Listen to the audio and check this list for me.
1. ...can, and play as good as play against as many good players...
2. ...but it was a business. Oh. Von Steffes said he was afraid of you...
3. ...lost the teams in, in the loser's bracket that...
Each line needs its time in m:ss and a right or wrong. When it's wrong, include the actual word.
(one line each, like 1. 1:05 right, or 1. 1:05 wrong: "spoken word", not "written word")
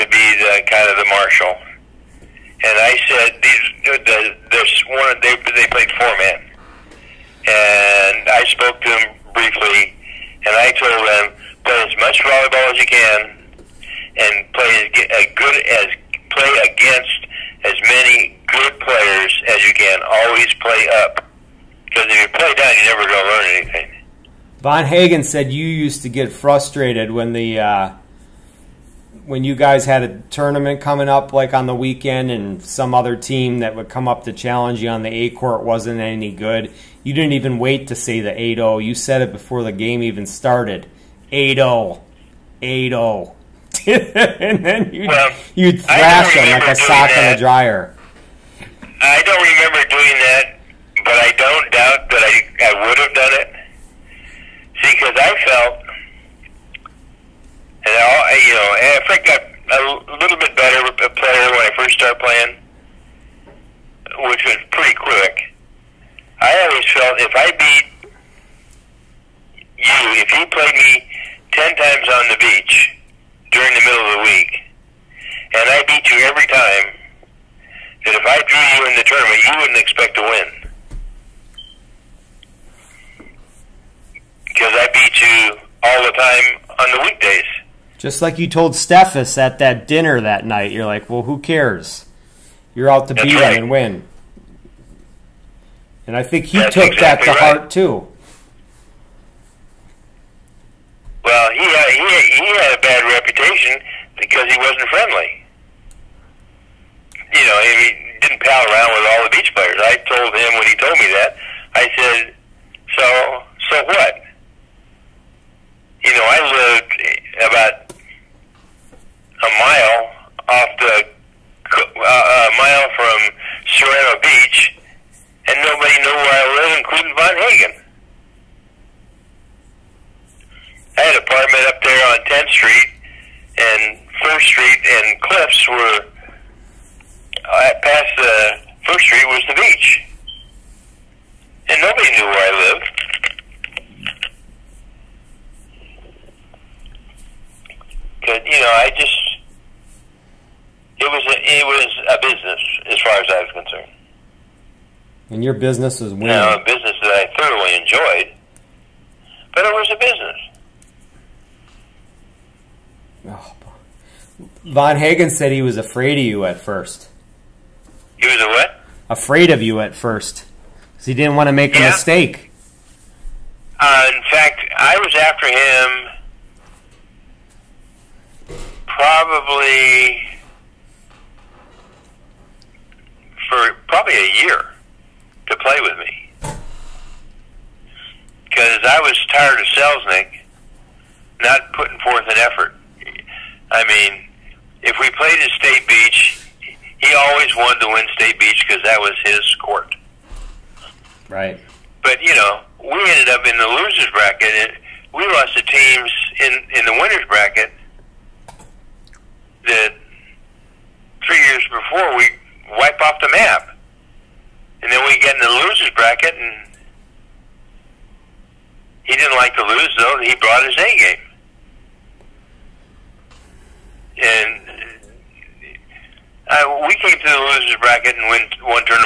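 1. 0:12 right
2. 2:39 wrong: "Hagen", not "Steffes"
3. 3:25 wrong: "winner", not "loser".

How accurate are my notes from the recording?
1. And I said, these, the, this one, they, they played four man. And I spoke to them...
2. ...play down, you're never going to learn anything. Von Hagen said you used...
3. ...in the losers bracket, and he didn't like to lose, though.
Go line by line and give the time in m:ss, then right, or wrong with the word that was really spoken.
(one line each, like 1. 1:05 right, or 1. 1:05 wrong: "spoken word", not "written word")
1. 0:02 right
2. 0:22 right
3. 3:35 right.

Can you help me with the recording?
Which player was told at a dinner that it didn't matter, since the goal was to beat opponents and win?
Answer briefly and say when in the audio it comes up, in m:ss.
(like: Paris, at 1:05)
Steffes, at 1:28.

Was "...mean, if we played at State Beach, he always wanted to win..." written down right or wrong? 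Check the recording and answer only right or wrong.
right.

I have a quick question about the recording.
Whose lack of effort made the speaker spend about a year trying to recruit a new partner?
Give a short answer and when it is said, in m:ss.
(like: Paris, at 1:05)
Selznick, at 3:09.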